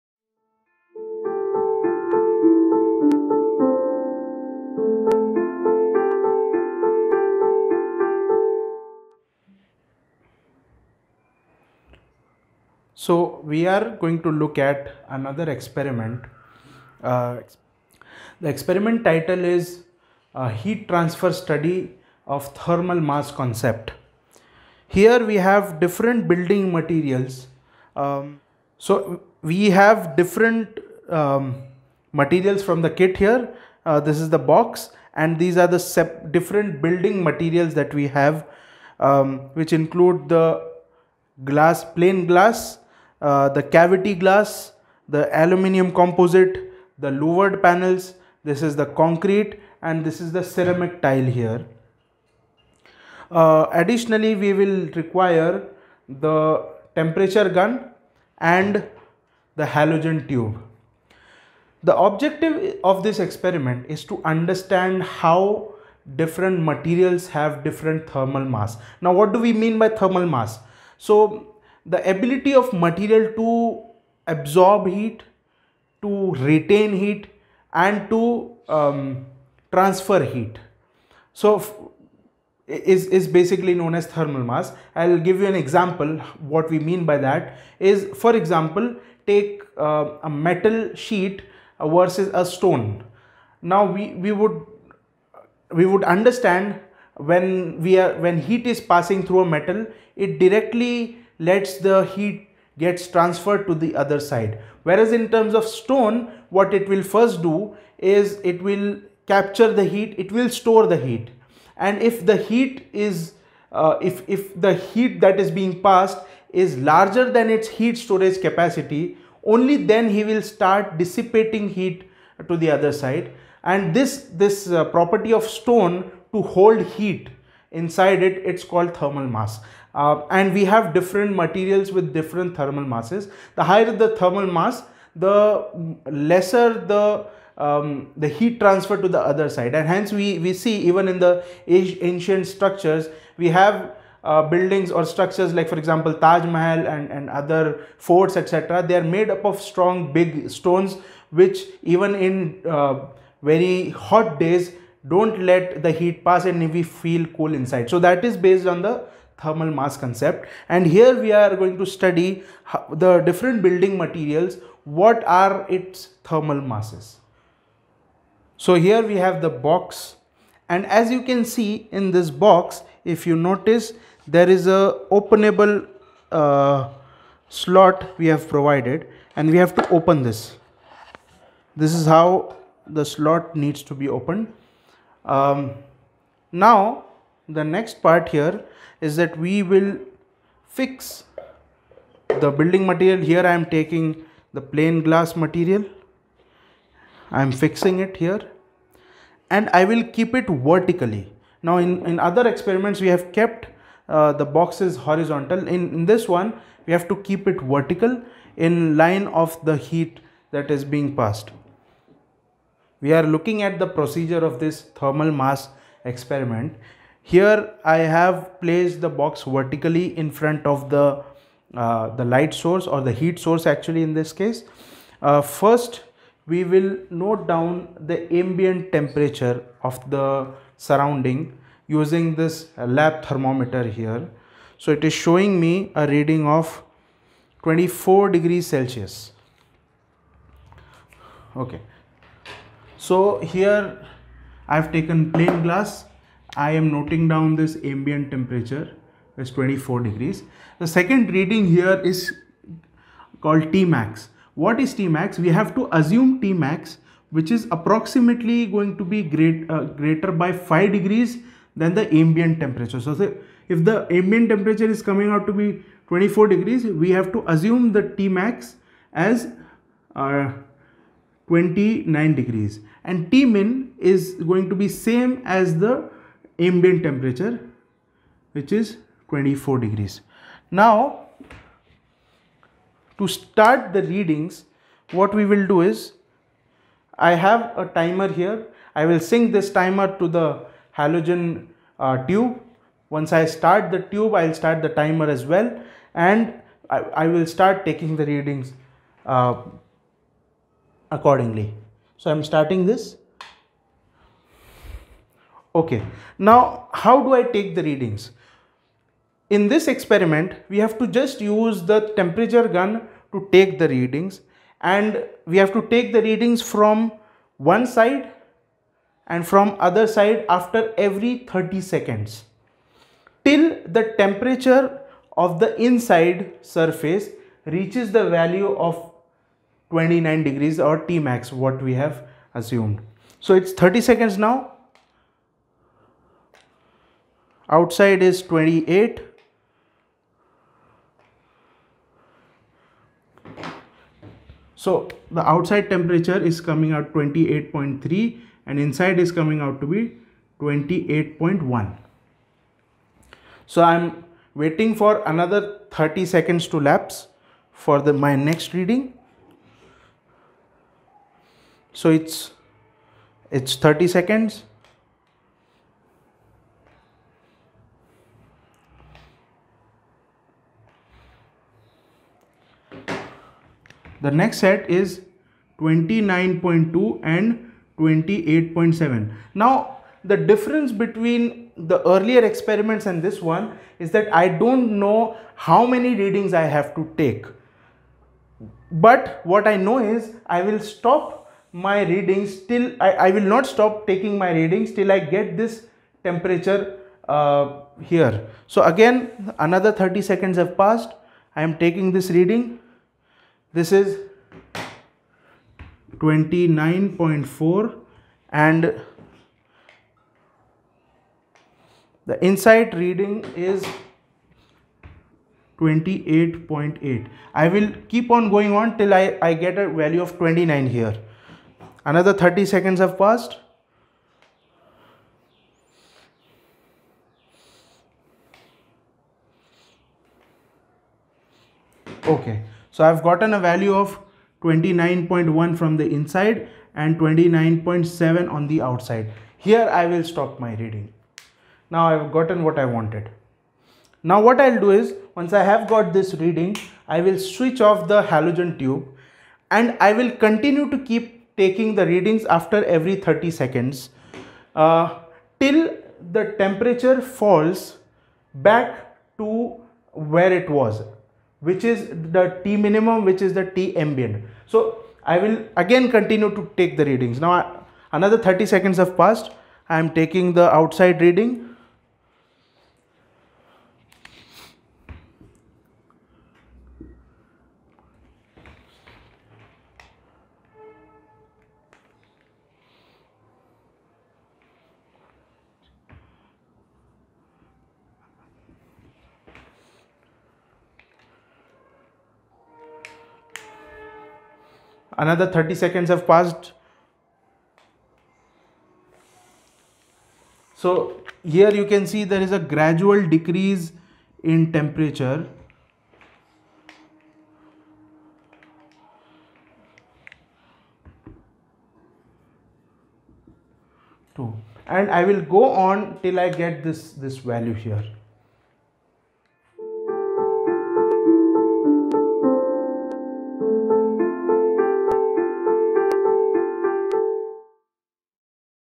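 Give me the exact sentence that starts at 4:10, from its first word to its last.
The second reading here is called T max.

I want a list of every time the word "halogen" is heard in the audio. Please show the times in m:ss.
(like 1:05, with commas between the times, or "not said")
0:59, 4:50, 7:28.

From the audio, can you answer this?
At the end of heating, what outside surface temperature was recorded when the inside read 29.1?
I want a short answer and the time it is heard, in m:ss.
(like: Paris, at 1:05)
29.7, at 7:17.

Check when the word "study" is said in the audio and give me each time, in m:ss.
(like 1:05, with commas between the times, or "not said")
0:21, 2:41.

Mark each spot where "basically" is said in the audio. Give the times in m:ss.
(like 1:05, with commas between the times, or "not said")
1:23.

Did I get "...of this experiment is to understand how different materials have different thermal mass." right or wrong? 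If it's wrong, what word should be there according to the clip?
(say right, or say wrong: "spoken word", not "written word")
right.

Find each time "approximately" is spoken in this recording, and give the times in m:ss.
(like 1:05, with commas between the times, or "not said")
4:17.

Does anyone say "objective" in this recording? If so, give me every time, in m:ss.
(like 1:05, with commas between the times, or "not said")
1:01.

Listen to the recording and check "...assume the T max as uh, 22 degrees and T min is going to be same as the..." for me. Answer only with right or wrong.
wrong.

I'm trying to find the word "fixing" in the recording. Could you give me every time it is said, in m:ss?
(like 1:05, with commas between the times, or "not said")
3:17.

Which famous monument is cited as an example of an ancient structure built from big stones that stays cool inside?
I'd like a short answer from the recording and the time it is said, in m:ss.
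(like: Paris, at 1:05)
Taj Mahal, at 2:26.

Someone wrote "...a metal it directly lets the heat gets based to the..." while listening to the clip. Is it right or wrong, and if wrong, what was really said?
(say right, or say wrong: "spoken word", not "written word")
wrong: "transferred", not "based".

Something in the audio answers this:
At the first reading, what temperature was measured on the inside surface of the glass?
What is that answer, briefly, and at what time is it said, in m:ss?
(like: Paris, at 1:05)
28.1, at 5:50.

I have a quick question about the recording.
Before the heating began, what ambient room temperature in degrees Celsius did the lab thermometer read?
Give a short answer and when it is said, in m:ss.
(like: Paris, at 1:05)
24, at 3:57.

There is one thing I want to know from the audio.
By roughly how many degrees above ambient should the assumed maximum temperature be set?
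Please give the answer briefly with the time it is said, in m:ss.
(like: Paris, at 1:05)
5, at 4:20.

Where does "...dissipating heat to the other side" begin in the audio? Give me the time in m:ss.
2:00.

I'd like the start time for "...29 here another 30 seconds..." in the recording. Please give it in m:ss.
7:00.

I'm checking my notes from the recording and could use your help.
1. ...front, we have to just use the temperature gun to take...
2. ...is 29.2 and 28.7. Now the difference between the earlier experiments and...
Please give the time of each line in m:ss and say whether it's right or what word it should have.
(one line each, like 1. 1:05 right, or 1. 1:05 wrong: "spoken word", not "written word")
1. 5:09 wrong: "experiment", not "front"
2. 6:14 right.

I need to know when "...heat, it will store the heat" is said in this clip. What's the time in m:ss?
1:49.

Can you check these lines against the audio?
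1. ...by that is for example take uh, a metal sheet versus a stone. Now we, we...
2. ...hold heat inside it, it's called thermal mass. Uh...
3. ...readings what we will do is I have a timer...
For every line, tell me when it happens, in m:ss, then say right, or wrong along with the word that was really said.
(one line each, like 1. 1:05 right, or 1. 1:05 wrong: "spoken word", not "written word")
1. 1:27 right
2. 2:06 right
3. 4:44 right.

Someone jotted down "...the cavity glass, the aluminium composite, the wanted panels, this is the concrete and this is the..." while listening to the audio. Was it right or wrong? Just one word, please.
wrong.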